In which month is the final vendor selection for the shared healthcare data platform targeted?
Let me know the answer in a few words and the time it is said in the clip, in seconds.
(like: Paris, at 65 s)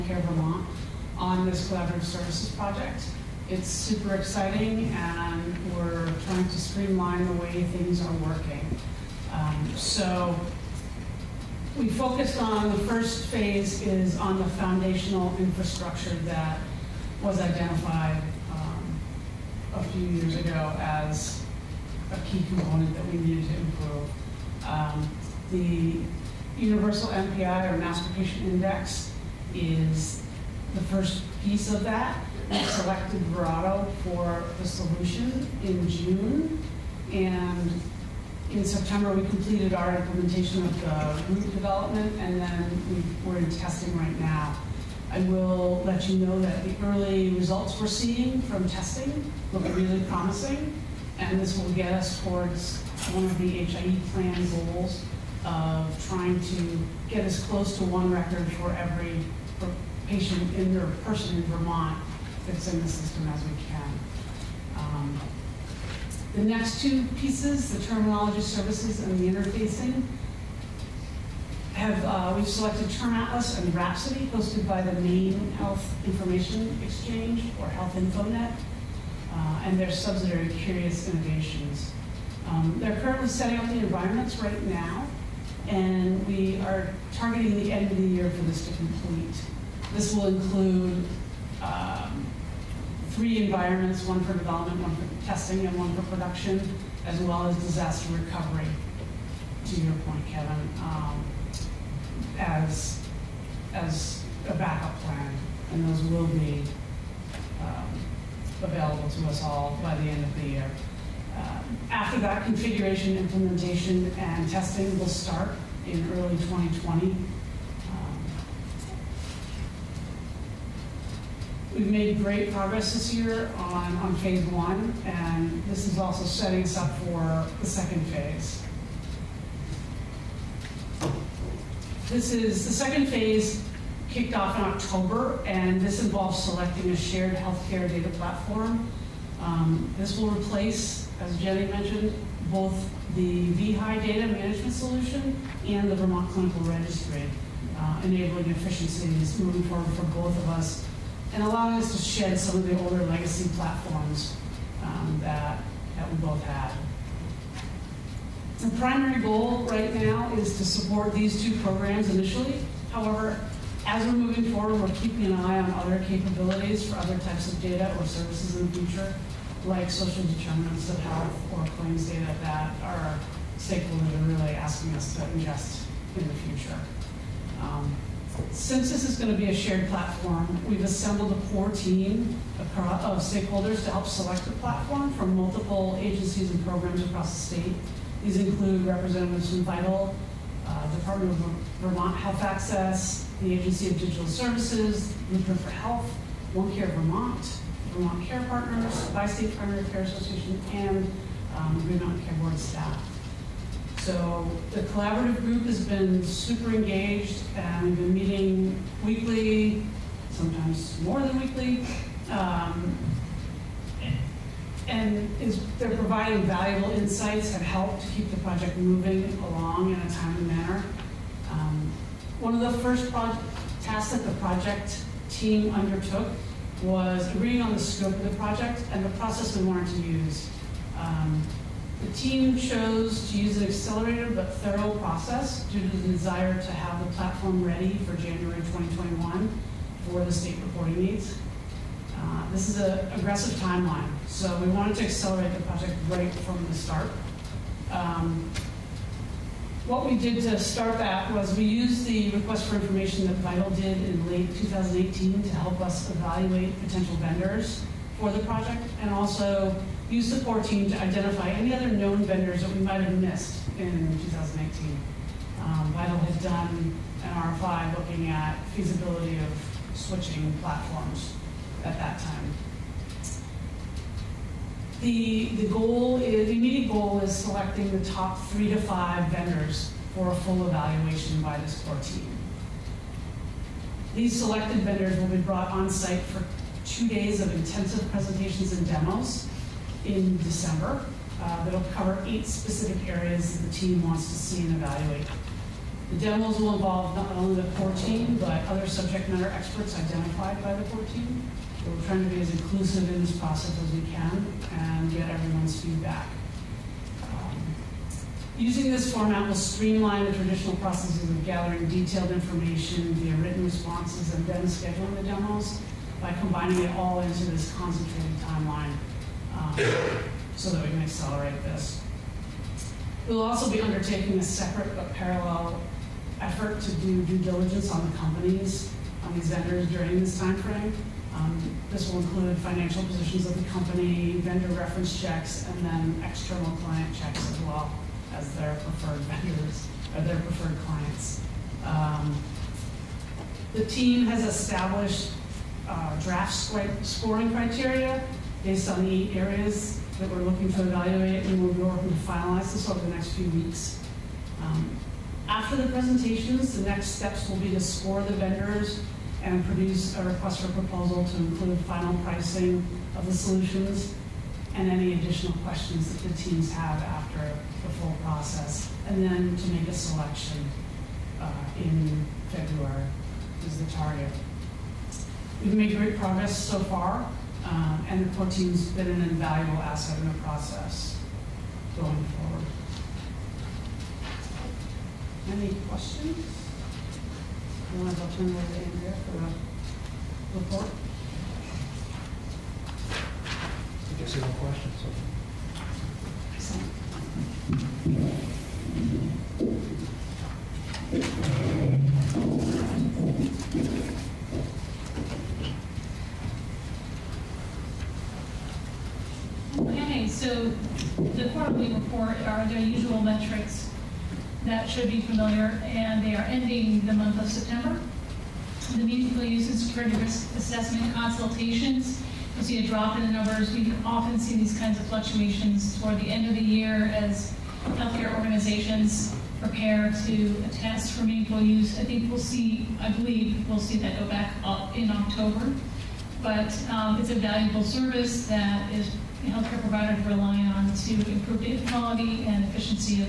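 February, at 372 s.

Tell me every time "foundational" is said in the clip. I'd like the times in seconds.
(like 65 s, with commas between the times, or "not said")
14 s.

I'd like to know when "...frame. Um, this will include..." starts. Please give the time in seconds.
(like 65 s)
330 s.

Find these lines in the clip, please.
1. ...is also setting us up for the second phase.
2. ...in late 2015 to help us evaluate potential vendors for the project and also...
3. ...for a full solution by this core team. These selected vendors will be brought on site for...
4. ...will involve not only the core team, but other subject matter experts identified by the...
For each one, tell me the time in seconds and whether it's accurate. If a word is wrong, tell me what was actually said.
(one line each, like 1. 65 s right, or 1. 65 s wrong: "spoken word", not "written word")
1. 125 s right
2. 254 s wrong: "2018", not "2015"
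3. 280 s wrong: "evaluation", not "solution"
4. 296 s right.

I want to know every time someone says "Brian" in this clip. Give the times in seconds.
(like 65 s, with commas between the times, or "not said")
not said.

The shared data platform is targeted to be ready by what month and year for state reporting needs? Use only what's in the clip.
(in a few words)
January 2021.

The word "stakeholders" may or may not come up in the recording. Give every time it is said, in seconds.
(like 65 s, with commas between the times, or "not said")
173 s, 183 s.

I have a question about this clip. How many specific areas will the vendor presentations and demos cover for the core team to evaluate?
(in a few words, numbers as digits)
8.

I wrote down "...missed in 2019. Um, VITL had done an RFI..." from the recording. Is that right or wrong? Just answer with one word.
right.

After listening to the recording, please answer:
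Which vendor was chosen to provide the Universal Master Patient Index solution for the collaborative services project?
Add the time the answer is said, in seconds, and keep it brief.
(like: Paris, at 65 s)
Verato, at 33 s.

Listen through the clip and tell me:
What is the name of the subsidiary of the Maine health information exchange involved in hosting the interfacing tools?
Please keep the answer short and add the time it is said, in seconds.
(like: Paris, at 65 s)
Curious Innovations, at 80 s.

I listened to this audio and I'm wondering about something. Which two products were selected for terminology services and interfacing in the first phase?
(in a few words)
Term Atlas and Rhapsody.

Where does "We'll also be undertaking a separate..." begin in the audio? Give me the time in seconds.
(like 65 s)
323 s.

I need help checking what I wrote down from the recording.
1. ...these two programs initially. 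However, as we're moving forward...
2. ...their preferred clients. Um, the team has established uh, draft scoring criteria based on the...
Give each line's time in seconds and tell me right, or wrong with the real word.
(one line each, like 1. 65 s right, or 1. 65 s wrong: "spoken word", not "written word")
1. 161 s right
2. 340 s right.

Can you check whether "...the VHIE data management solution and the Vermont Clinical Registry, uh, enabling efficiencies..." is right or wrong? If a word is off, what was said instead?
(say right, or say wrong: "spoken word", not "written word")
right.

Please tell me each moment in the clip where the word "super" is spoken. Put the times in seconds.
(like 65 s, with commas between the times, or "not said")
3 s, 206 s.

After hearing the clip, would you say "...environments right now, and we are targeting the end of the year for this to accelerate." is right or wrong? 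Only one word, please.
wrong.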